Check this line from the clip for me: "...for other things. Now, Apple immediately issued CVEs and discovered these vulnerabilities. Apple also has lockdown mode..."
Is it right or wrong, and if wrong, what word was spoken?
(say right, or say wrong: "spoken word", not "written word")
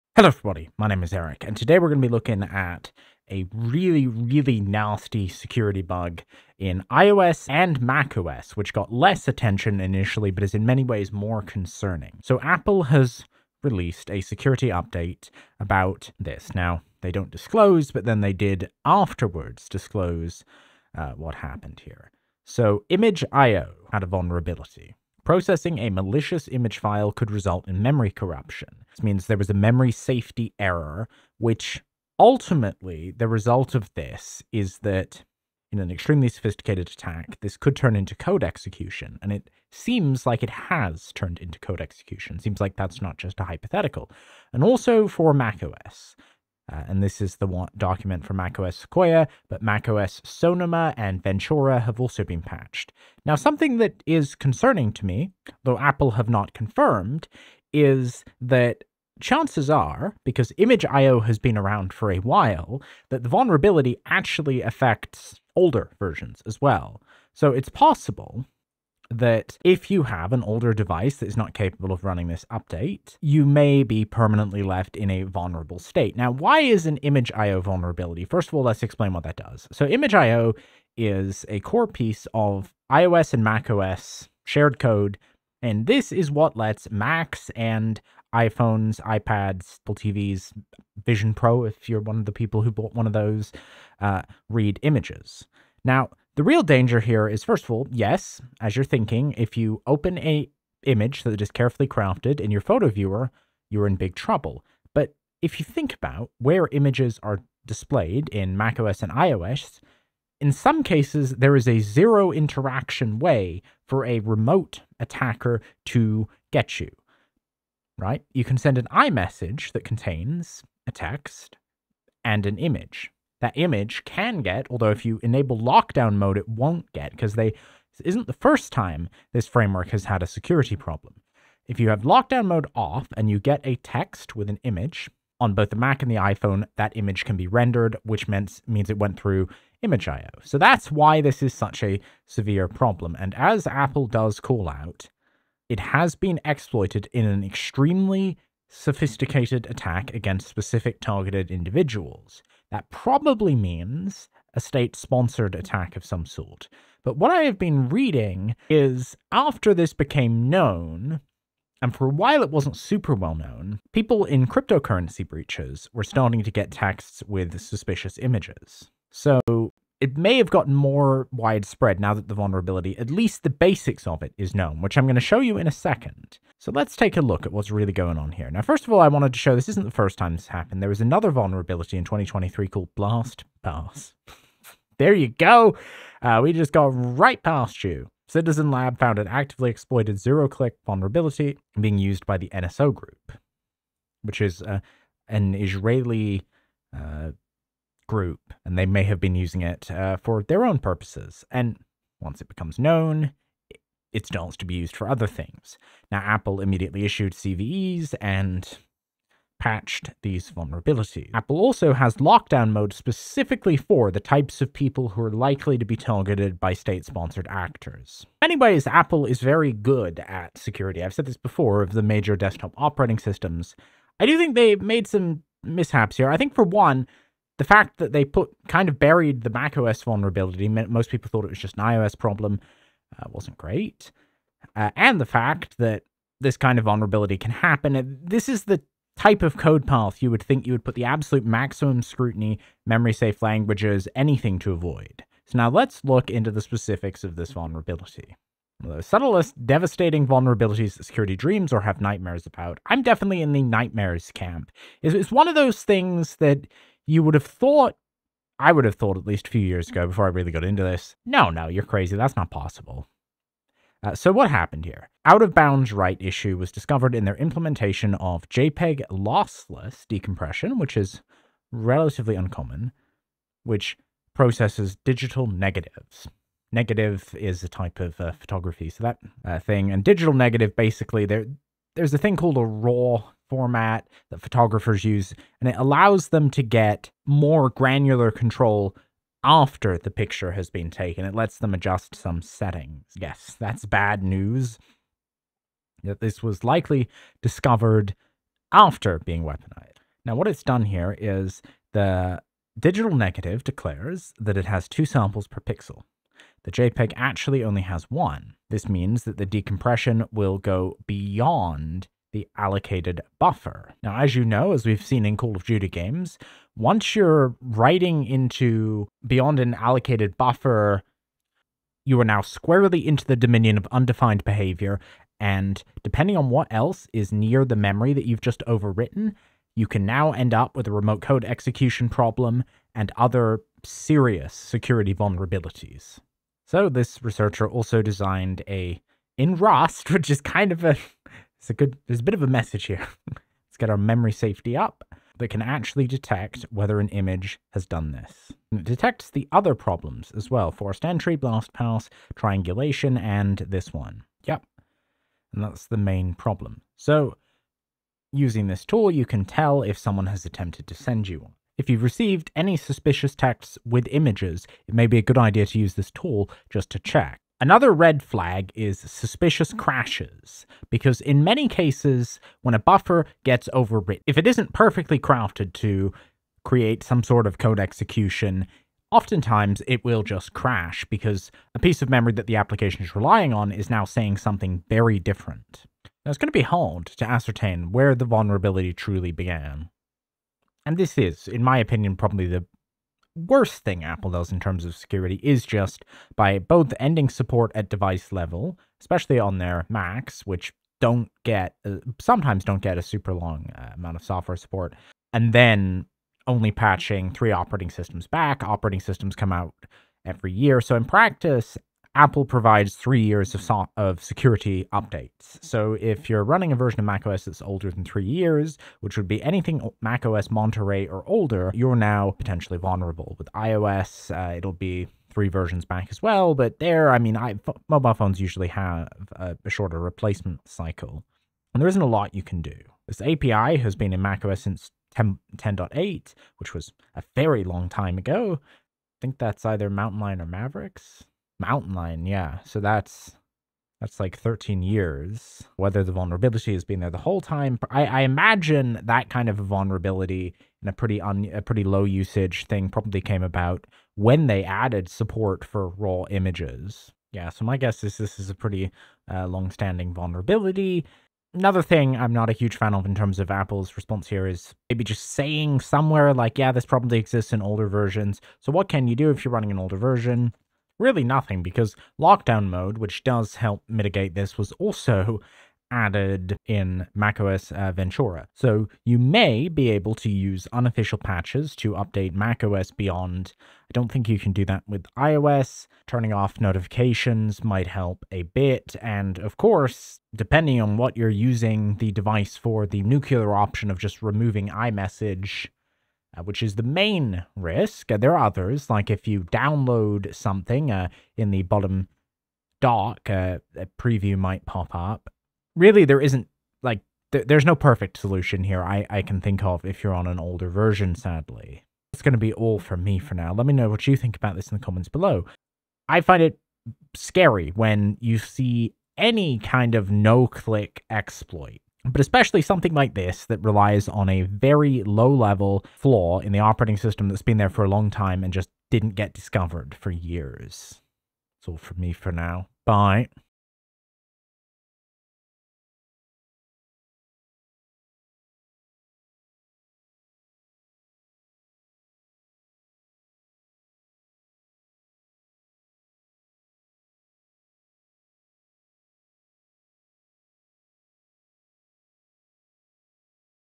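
wrong: "patched", not "discovered".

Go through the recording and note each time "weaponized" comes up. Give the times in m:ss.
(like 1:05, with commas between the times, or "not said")
4:59.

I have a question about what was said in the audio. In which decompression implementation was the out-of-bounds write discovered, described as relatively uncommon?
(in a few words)
JPEG lossless decompression.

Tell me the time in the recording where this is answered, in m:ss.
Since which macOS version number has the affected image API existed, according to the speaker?
7:15.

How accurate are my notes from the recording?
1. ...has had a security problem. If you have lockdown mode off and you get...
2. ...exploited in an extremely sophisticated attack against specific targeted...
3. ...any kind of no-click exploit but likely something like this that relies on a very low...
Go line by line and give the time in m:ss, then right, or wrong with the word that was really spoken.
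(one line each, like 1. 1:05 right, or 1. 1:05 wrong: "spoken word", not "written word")
1. 2:09 right
2. 2:26 right
3. 8:39 wrong: "especially", not "likely".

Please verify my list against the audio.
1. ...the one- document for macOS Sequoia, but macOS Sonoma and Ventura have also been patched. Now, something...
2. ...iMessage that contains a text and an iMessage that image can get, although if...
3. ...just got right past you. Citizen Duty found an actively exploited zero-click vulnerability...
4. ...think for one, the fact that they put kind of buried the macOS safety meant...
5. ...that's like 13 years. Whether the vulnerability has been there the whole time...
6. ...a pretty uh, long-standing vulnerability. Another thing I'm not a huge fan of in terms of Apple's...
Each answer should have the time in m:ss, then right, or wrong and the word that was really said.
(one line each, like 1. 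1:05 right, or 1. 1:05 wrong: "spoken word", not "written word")
1. 0:47 right
2. 1:58 wrong: "image", not "iMessage"
3. 3:06 wrong: "Lab", not "Duty"
4. 3:46 wrong: "vulnerability", not "safety"
5. 7:24 right
6. 7:38 right.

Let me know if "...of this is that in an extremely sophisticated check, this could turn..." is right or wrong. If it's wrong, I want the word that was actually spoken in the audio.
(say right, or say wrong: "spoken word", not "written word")
wrong: "attack", not "check".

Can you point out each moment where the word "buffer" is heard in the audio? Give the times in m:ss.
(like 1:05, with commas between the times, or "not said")
5:13, 5:20, 6:12.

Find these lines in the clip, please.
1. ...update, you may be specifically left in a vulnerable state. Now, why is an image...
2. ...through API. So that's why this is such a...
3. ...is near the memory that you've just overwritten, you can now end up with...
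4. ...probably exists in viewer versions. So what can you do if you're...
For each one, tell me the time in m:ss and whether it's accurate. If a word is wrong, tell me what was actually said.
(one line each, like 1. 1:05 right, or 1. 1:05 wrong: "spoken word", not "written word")
1. 1:12 wrong: "permanently", not "specifically"
2. 2:19 wrong: "ImageIO", not "API"
3. 5:27 right
4. 7:46 wrong: "older", not "viewer".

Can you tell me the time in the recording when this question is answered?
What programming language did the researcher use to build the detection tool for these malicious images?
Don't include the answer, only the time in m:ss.
5:39.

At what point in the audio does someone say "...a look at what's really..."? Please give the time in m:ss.
2:57.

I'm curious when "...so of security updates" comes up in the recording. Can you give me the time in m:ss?
6:53.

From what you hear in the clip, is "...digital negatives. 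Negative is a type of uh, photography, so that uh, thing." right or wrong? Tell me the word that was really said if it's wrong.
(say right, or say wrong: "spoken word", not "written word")
right.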